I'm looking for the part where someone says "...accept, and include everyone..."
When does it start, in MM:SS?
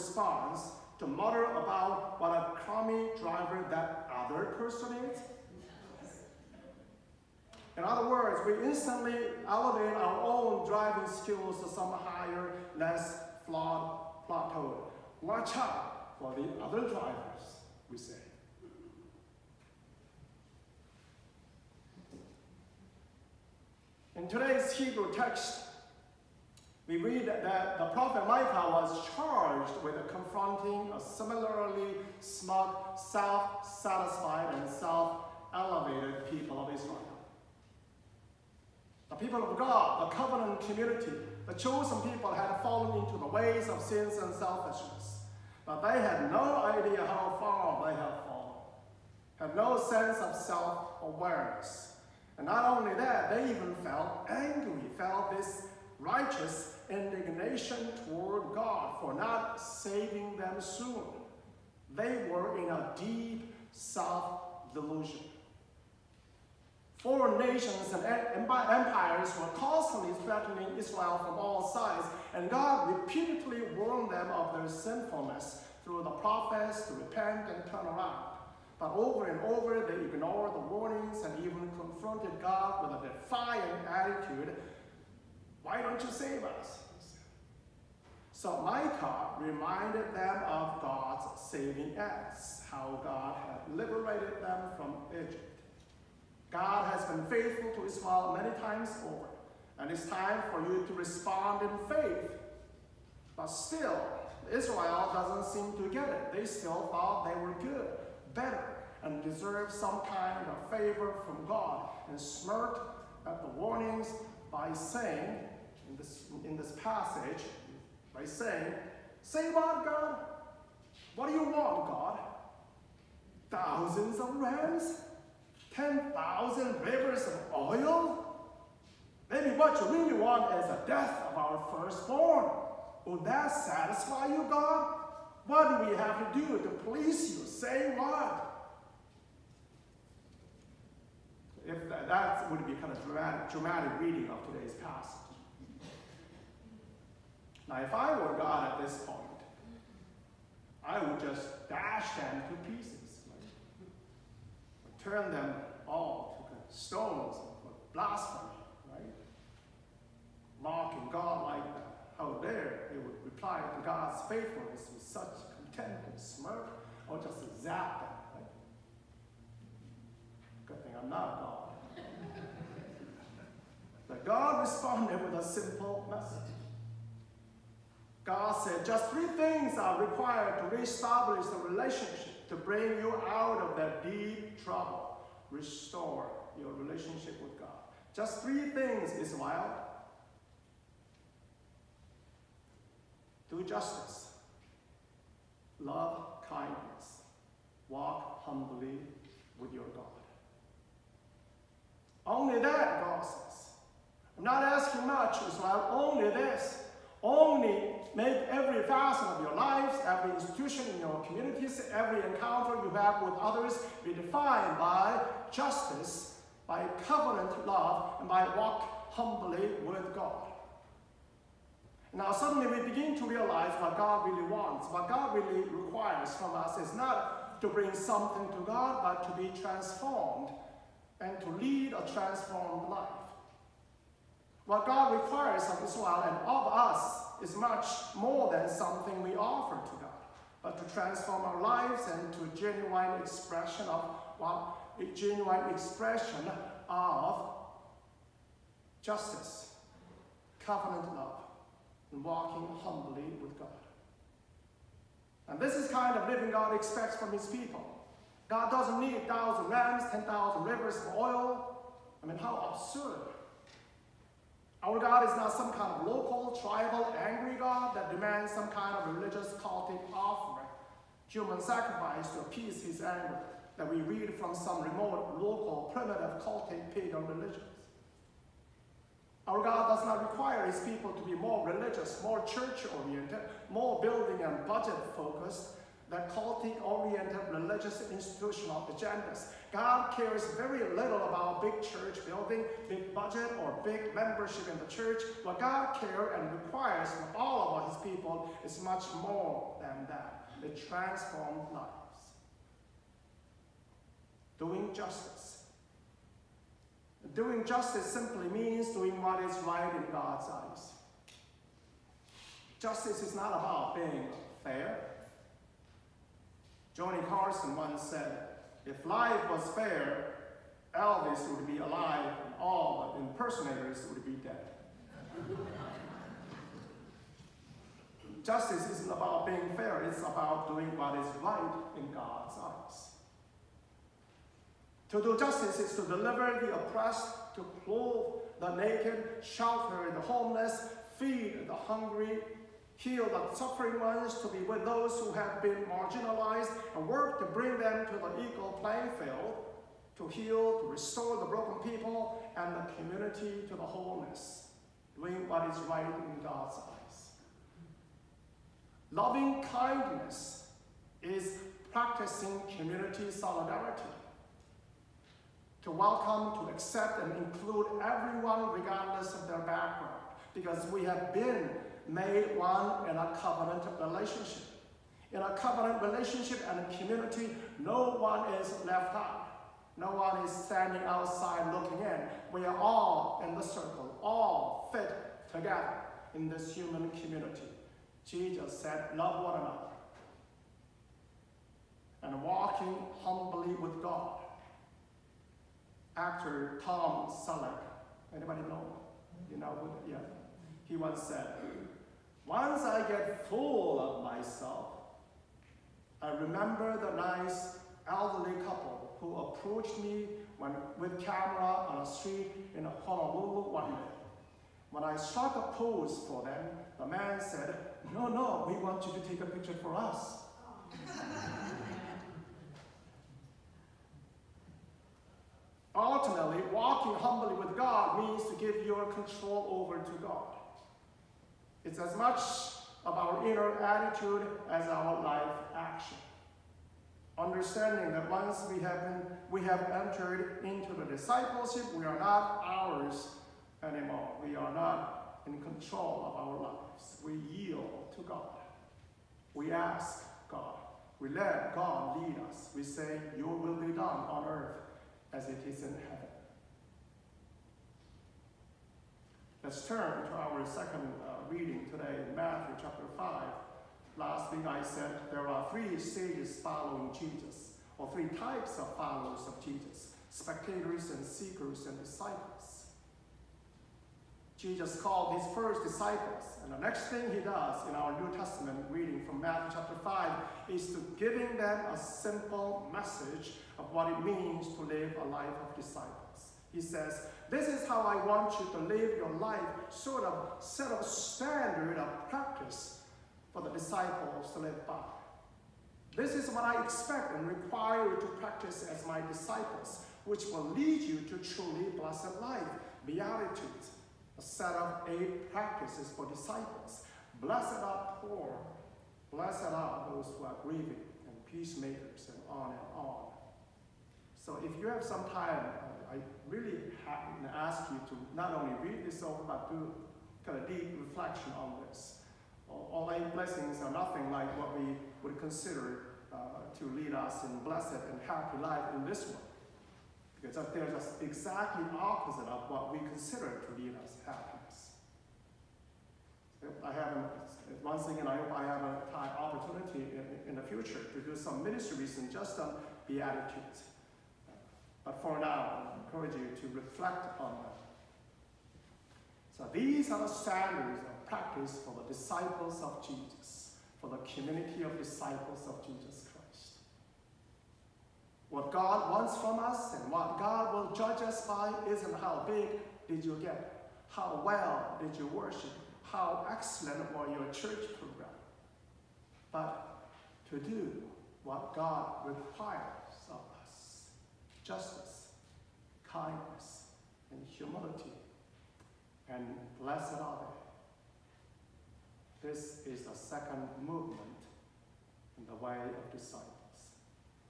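06:06.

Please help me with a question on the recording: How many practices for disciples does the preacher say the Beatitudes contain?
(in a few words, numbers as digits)
8.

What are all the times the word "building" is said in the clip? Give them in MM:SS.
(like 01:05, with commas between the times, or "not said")
04:44, 04:52.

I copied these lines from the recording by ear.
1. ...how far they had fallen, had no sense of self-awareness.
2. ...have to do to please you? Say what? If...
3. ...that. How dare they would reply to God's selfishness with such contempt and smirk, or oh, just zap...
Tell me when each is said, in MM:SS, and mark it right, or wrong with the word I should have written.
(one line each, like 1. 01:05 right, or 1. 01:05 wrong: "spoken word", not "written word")
1. 00:47 right
2. 02:15 right
3. 02:41 wrong: "faithfulness", not "selfishness".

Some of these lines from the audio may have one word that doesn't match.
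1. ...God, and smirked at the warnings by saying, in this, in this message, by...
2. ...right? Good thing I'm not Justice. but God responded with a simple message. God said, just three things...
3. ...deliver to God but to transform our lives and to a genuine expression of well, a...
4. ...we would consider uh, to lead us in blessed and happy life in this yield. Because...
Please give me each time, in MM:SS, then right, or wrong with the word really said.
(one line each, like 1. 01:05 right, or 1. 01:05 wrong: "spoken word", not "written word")
1. 01:51 wrong: "passage", not "message"
2. 02:50 wrong: "God", not "Justice"
3. 03:59 wrong: "offer", not "deliver"
4. 08:44 wrong: "world", not "yield".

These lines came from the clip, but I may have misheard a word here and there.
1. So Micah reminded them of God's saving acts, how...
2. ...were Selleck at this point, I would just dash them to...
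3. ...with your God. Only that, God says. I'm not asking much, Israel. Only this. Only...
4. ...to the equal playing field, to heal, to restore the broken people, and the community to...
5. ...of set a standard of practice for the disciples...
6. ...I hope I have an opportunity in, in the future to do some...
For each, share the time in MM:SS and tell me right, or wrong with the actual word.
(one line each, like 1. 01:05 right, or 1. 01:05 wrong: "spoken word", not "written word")
1. 01:28 right
2. 02:28 wrong: "God", not "Selleck"
3. 03:19 right
4. 05:48 right
5. 08:10 right
6. 08:58 right.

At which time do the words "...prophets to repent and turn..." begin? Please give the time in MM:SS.
01:16.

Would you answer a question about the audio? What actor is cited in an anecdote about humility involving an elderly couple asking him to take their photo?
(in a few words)
Tom Selleck.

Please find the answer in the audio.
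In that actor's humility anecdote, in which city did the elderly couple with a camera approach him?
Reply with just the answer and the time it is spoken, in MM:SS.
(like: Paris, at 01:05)
Honolulu, at 06:53.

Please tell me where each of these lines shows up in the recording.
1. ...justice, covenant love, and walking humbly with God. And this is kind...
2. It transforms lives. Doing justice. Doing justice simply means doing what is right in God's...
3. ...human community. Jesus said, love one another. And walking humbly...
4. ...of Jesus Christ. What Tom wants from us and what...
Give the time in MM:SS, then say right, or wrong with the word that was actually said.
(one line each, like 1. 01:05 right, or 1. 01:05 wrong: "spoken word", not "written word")
1. 04:09 right
2. 05:00 right
3. 06:26 right
4. 09:15 wrong: "God", not "Tom".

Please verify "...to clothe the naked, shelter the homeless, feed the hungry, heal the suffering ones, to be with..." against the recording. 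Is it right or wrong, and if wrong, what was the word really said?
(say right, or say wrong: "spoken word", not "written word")
right.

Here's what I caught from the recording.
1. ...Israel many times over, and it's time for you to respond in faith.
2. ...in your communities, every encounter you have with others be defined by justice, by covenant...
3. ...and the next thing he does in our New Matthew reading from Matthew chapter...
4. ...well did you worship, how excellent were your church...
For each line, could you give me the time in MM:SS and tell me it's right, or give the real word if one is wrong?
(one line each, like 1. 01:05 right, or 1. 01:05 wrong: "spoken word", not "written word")
1. 01:37 right
2. 03:30 right
3. 07:56 wrong: "Testament", not "Matthew"
4. 09:24 right.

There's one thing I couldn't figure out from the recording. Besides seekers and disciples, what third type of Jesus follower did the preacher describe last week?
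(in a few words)
Spectators.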